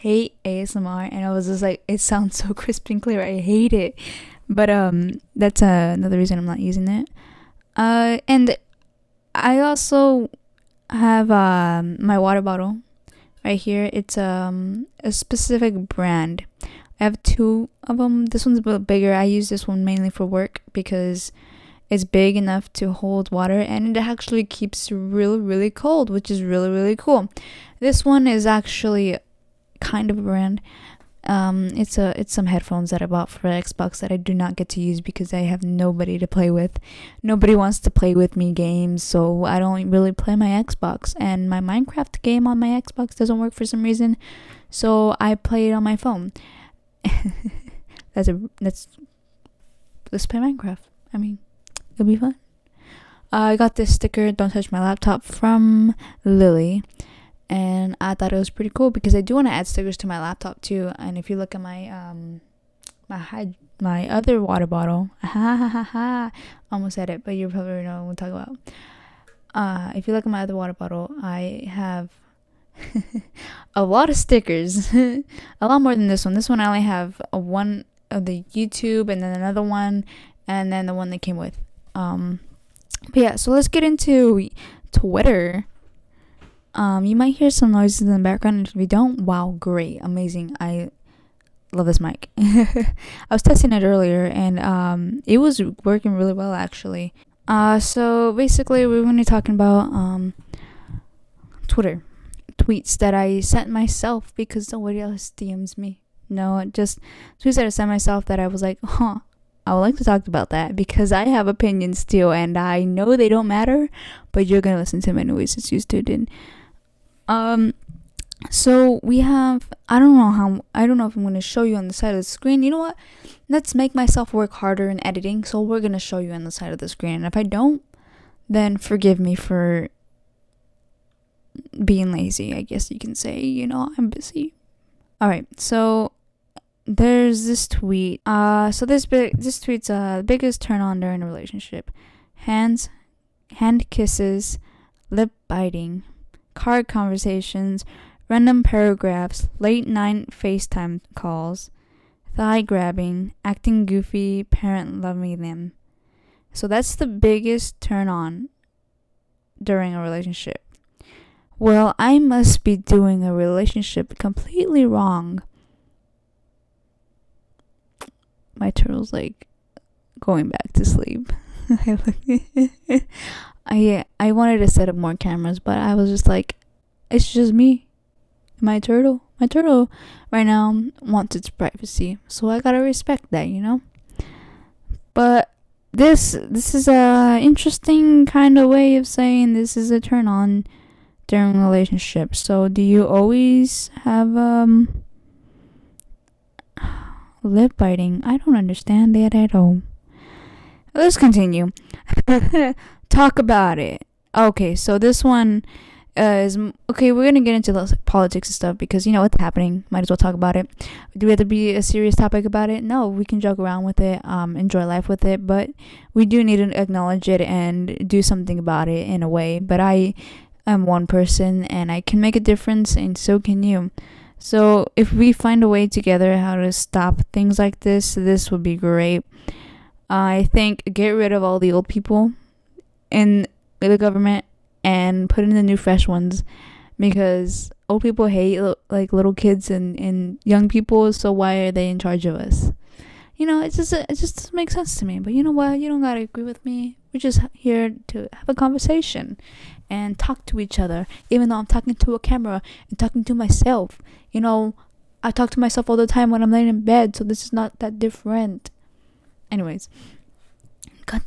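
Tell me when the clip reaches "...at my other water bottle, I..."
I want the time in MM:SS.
01:10.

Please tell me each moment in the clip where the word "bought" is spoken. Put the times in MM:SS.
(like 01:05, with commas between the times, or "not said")
00:33.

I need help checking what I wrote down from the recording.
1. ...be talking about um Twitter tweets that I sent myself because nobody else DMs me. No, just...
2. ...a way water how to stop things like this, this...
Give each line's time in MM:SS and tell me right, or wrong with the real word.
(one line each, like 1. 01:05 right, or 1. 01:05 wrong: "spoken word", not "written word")
1. 01:39 right
2. 03:45 wrong: "together", not "water".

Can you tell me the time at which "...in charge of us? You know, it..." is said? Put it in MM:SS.
04:01.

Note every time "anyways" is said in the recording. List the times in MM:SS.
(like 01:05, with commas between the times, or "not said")
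01:55, 04:19.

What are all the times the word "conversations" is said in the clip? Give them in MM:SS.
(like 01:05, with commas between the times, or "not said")
02:26, 04:08.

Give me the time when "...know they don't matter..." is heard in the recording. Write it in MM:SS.
01:52.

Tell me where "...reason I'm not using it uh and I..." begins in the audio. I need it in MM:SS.
00:06.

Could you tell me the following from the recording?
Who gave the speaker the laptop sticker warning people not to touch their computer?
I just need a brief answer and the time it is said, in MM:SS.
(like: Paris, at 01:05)
Lily, at 00:56.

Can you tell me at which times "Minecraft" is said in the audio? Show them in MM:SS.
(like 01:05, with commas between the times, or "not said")
00:41, 00:50.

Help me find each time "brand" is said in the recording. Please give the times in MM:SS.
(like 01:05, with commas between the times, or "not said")
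00:15, 00:30.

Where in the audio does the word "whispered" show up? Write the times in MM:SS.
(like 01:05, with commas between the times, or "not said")
not said.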